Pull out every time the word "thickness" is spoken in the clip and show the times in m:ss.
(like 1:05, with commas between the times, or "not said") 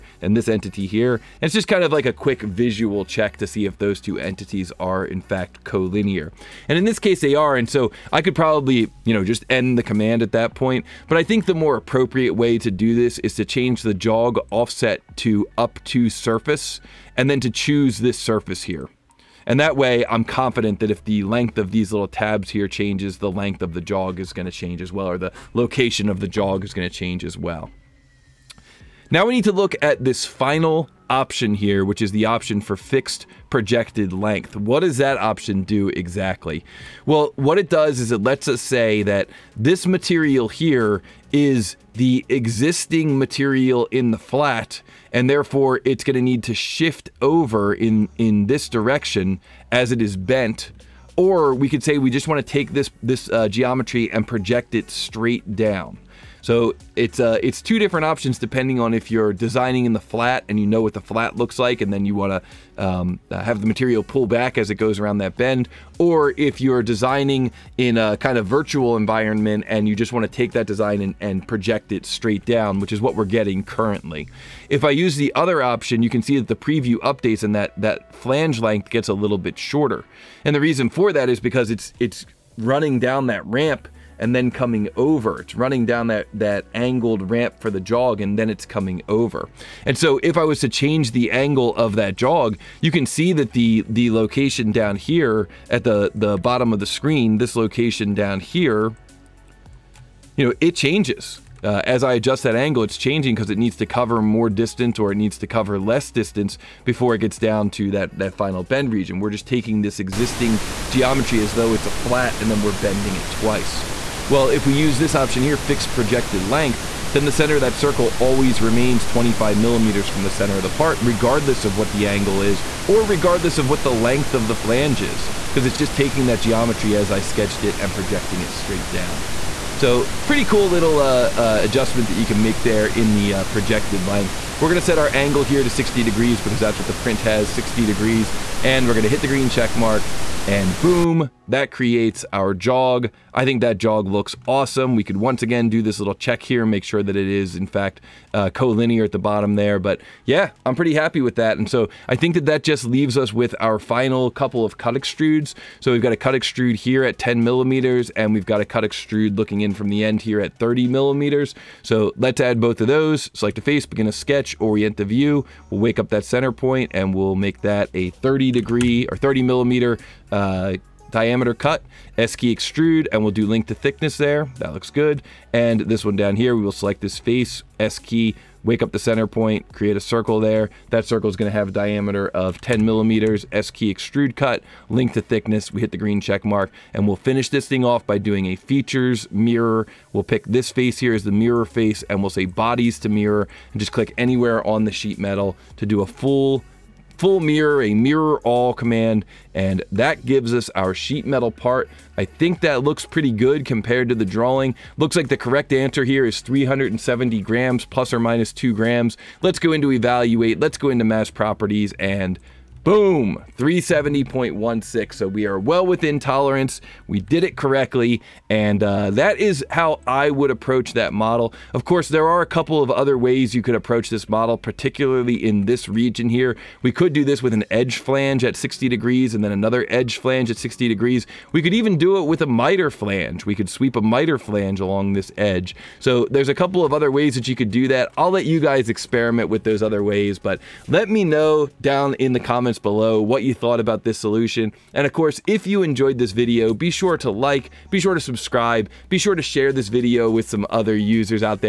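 2:53, 3:05.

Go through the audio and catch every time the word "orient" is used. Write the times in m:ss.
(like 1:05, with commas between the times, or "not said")
2:44.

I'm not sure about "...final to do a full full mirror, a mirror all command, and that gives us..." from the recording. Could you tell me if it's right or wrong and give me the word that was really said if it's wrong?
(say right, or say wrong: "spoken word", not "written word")
wrong: "metal", not "final".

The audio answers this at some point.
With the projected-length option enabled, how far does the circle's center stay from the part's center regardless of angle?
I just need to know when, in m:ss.
1:59.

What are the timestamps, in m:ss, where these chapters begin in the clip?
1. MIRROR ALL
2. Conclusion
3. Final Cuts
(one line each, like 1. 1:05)
1. 3:07
2. 3:32
3. 2:35.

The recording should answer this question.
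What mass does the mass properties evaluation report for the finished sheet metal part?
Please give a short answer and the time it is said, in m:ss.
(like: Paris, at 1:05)
370.16, at 3:33.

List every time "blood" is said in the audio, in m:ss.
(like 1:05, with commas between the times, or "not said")
not said.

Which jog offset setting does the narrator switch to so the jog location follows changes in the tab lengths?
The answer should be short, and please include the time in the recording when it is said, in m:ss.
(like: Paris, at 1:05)
Up to surface, at 0:15.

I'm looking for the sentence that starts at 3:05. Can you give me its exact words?
We hit the green check mark, and we'll finish this thing off by doing a features mirror.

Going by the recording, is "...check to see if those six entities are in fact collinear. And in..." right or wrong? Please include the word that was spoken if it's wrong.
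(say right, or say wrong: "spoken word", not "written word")
wrong: "two", not "six".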